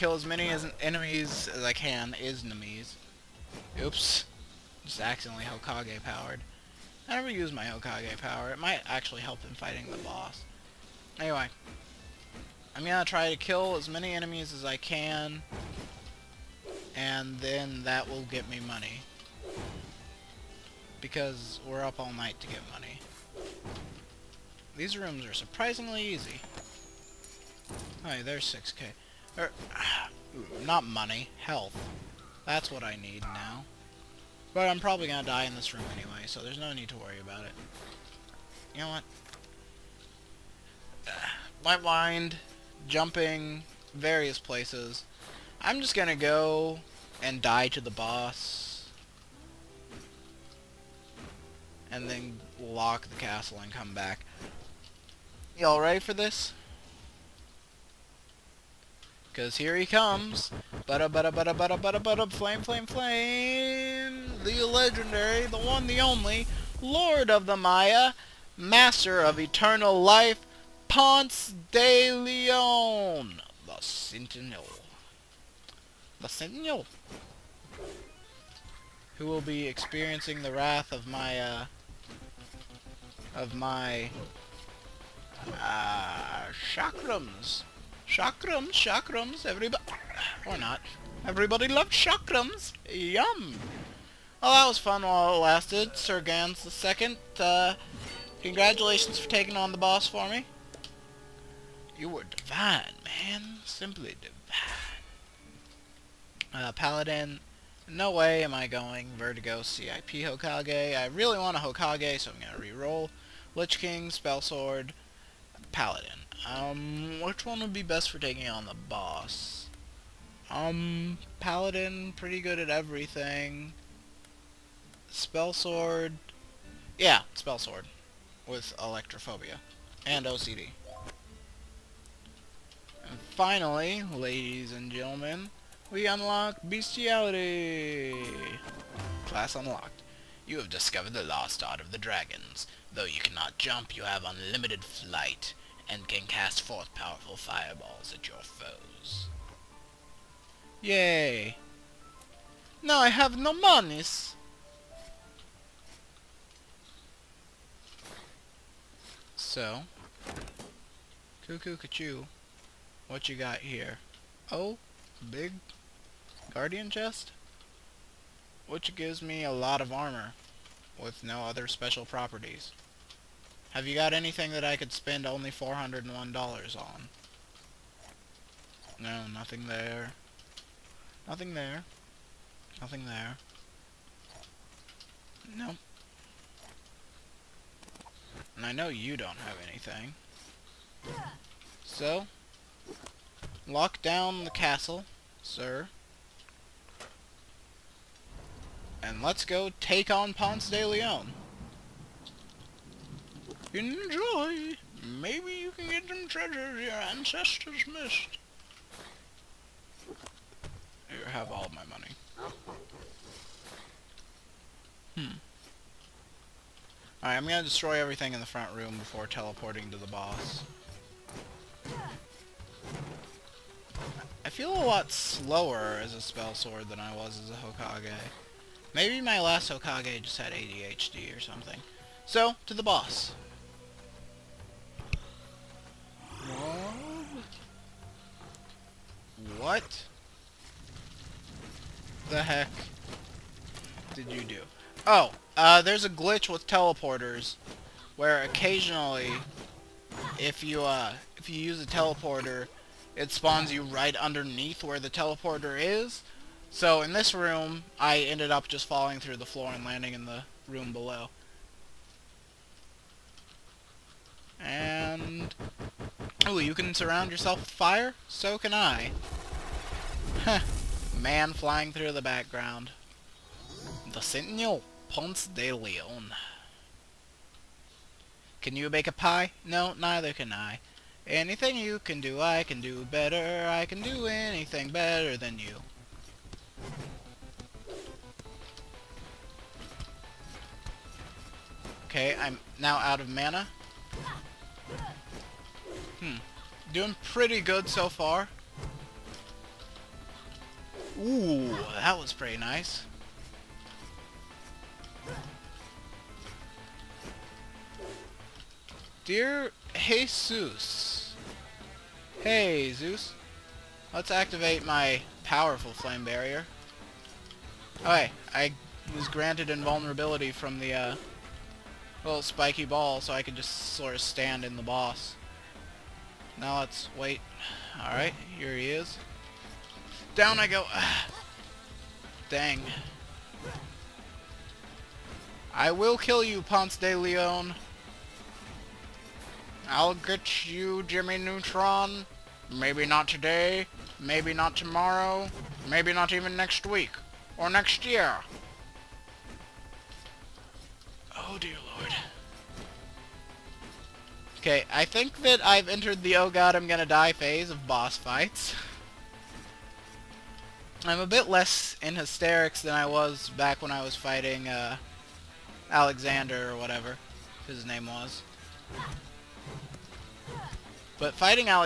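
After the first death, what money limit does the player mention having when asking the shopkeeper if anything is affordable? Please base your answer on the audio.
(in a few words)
$401.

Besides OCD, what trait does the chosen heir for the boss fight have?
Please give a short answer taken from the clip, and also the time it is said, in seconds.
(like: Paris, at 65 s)
Electrophobia, at 128 s.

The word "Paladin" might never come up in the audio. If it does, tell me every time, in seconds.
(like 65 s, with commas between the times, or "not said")
106 s, 115 s, 121 s.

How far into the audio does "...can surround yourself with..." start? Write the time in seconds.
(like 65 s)
266 s.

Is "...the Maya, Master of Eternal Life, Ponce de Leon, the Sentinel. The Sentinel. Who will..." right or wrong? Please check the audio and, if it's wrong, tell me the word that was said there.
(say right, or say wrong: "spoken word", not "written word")
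right.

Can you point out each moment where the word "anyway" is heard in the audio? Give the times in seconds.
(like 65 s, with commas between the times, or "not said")
11 s, 35 s.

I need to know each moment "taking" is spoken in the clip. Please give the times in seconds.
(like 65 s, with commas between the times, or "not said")
99 s, 118 s.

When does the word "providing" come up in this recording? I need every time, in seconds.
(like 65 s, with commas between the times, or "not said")
not said.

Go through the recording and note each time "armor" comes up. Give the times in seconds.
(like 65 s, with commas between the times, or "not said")
169 s.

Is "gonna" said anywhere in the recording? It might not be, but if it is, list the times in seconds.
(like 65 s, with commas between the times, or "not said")
35 s, 45 s, 217 s, 356 s.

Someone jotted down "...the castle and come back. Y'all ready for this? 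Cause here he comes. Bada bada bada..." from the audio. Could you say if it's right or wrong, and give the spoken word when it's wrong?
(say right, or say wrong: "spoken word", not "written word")
right.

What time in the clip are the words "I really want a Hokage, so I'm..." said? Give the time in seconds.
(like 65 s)
110 s.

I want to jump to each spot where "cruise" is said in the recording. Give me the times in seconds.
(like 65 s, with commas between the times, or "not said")
not said.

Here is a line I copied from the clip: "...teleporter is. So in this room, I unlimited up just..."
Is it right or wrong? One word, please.
wrong.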